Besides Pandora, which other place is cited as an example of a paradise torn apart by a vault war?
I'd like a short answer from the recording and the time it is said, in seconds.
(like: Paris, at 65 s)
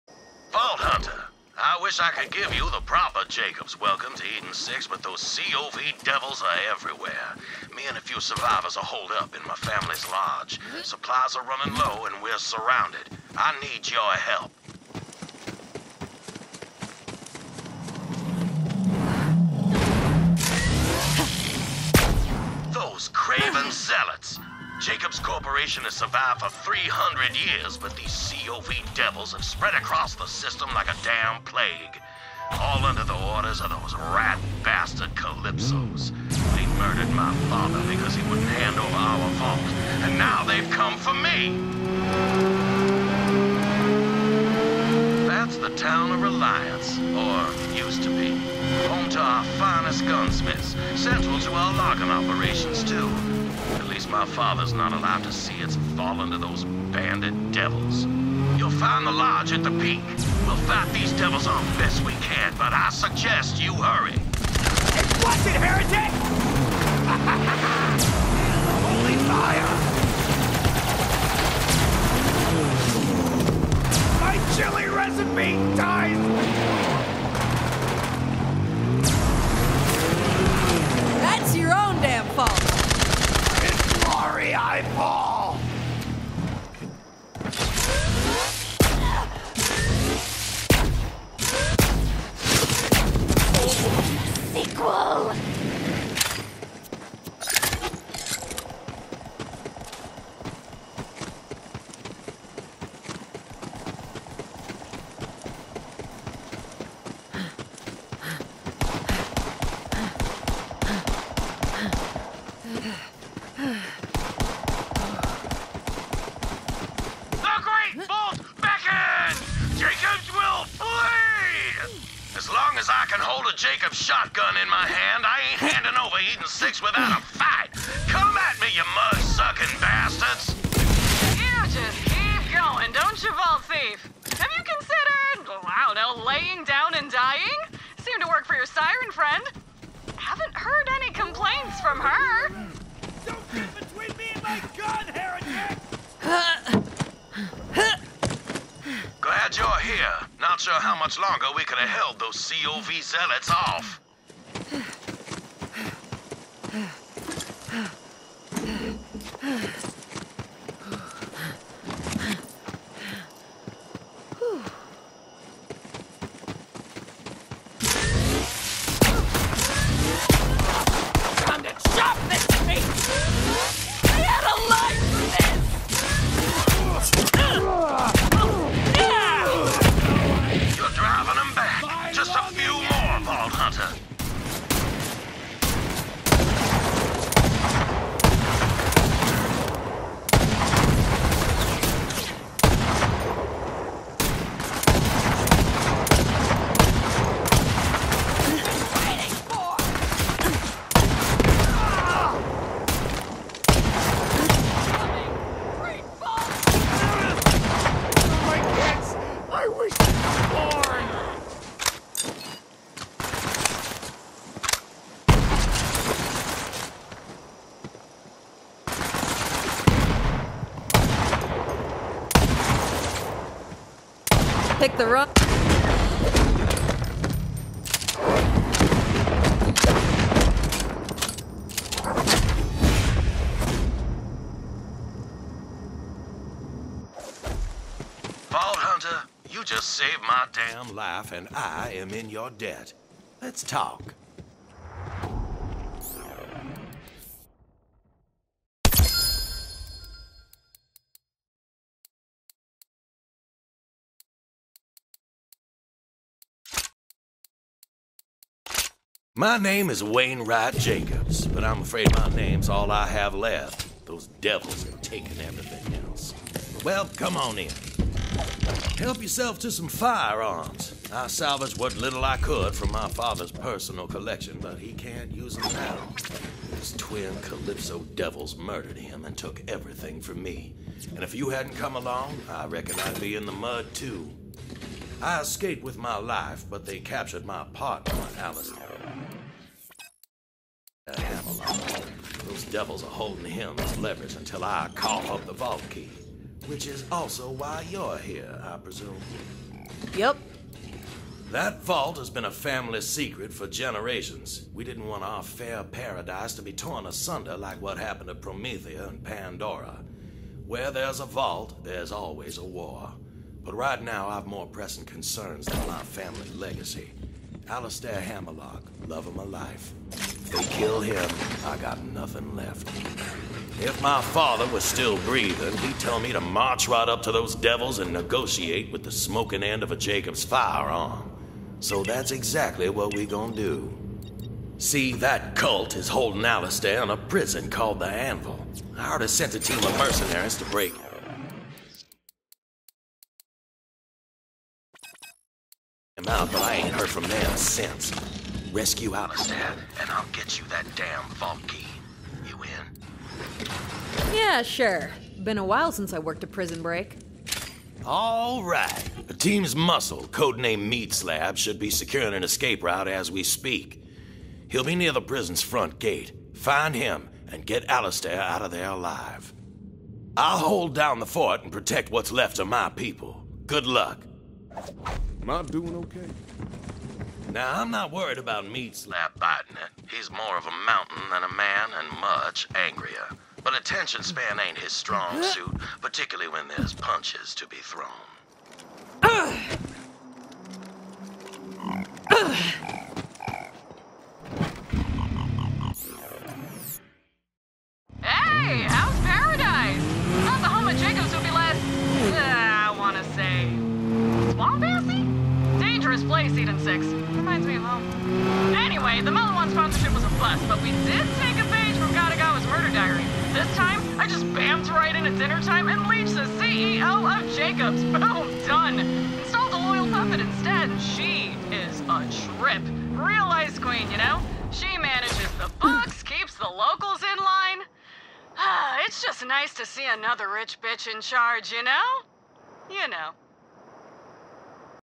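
Promethea, at 308 s.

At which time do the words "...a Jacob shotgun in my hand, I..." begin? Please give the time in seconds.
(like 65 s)
123 s.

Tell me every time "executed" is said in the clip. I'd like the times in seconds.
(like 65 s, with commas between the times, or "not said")
not said.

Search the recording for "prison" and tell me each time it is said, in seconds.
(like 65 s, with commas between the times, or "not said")
337 s, 356 s, 365 s.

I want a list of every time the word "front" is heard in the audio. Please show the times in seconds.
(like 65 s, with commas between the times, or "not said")
365 s.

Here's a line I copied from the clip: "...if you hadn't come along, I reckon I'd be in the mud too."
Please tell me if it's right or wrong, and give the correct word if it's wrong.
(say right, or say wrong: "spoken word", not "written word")
right.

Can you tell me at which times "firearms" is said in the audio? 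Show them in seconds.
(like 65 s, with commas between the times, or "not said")
269 s, 330 s.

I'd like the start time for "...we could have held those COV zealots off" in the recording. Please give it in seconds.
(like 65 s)
151 s.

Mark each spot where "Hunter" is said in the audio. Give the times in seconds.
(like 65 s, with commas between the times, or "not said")
0 s, 238 s.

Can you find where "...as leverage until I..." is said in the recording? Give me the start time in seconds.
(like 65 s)
293 s.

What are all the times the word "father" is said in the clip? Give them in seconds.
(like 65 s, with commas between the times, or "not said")
37 s, 54 s, 273 s, 324 s.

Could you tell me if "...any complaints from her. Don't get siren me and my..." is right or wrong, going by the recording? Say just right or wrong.
wrong.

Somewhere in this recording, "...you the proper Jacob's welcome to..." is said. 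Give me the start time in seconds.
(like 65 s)
2 s.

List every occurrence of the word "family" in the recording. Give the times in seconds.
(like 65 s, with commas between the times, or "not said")
9 s, 302 s, 316 s.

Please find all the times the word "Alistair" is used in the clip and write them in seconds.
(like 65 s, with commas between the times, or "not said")
288 s, 317 s, 336 s, 349 s, 367 s.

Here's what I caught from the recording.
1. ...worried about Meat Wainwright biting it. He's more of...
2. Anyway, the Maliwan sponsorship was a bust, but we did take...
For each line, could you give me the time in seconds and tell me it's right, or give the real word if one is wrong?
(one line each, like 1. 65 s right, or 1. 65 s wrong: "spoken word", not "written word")
1. 378 s wrong: "Slab", not "Wainwright"
2. 409 s right.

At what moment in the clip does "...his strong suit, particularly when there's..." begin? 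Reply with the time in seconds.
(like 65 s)
384 s.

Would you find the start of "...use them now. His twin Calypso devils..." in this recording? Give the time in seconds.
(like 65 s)
275 s.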